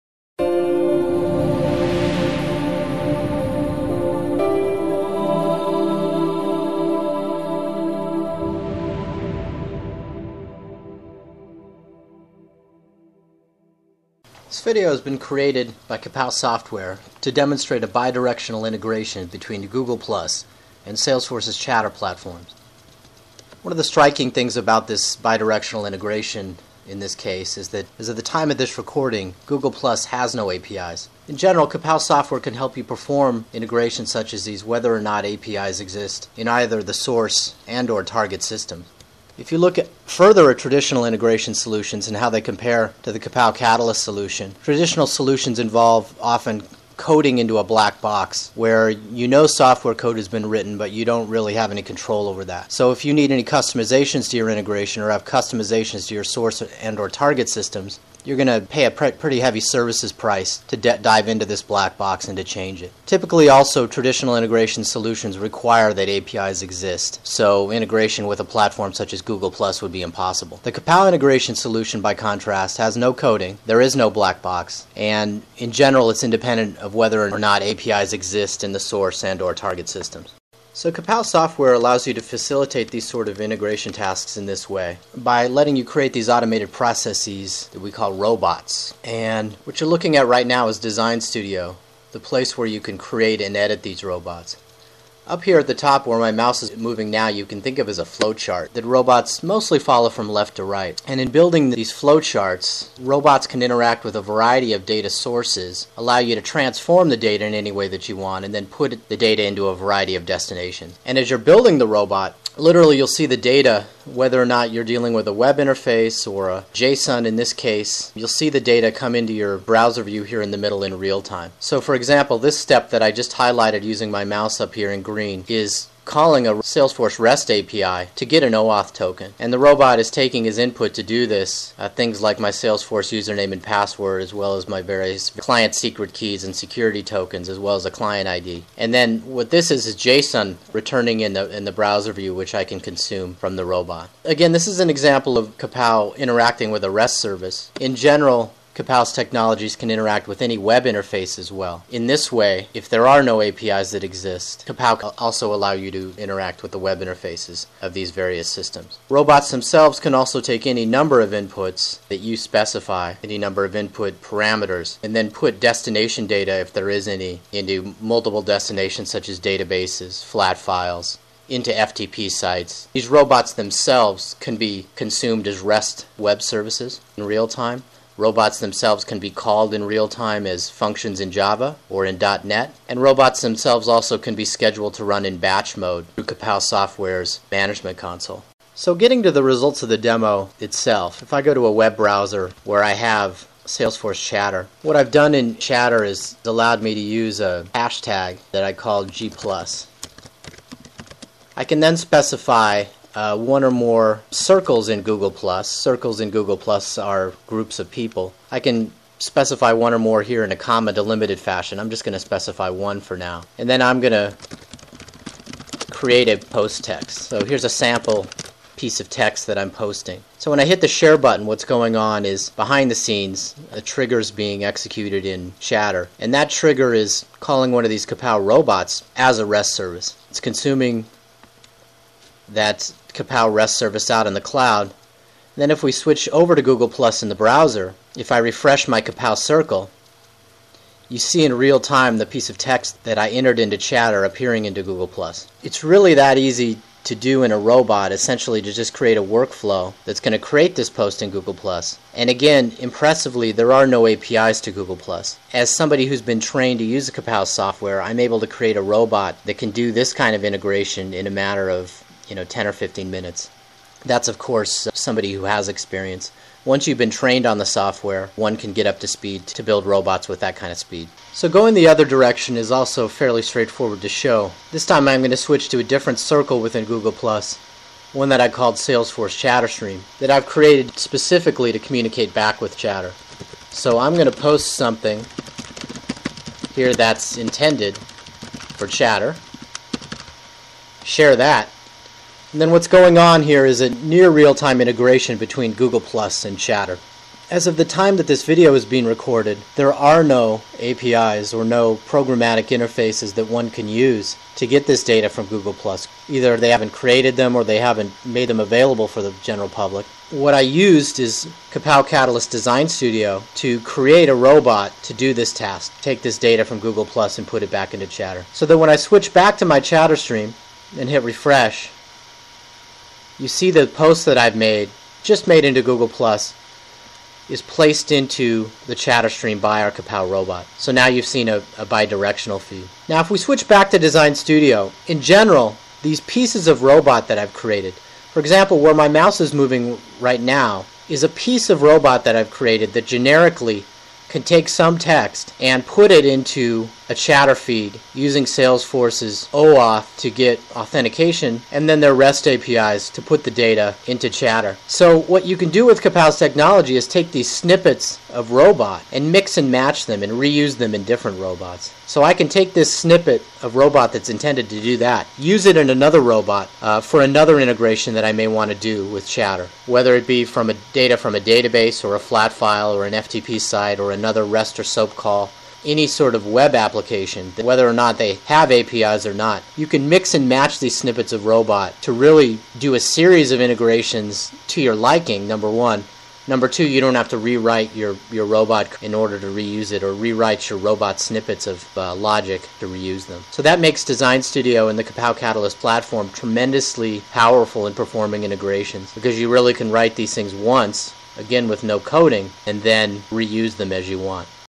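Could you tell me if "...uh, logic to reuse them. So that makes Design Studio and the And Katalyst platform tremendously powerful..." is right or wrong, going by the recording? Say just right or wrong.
wrong.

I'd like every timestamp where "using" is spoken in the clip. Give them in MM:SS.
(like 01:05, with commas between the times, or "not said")
02:03, 05:48.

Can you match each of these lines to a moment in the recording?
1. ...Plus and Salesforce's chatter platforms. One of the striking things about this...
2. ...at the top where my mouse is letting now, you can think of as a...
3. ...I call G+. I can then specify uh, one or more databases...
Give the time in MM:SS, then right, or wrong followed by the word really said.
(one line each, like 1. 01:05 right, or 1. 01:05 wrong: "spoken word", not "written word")
1. 00:19 right
2. 01:35 wrong: "moving", not "letting"
3. 03:18 wrong: "circles", not "databases".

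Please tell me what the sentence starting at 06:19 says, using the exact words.
You can mix and match these snippets of robot to really do a series of integrations to your liking, number one.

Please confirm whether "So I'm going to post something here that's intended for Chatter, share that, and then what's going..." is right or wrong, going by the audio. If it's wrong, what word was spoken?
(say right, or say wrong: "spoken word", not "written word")
right.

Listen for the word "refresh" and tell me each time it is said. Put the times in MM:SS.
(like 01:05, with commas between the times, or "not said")
03:58, 05:21.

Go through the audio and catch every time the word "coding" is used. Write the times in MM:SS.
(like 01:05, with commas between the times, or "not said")
00:46, 01:13, 06:41.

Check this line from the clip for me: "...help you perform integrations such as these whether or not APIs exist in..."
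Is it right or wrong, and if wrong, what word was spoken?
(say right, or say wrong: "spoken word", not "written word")
right.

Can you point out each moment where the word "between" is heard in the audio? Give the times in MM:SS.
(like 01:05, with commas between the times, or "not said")
00:19, 04:55.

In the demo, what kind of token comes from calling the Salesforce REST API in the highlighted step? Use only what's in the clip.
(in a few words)
OAuth token.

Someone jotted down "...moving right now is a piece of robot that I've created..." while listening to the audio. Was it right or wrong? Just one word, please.
right.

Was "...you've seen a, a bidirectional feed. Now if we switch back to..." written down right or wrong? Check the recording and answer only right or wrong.
right.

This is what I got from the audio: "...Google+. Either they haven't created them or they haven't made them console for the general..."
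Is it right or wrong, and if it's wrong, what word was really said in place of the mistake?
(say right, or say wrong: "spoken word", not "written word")
wrong: "available", not "console".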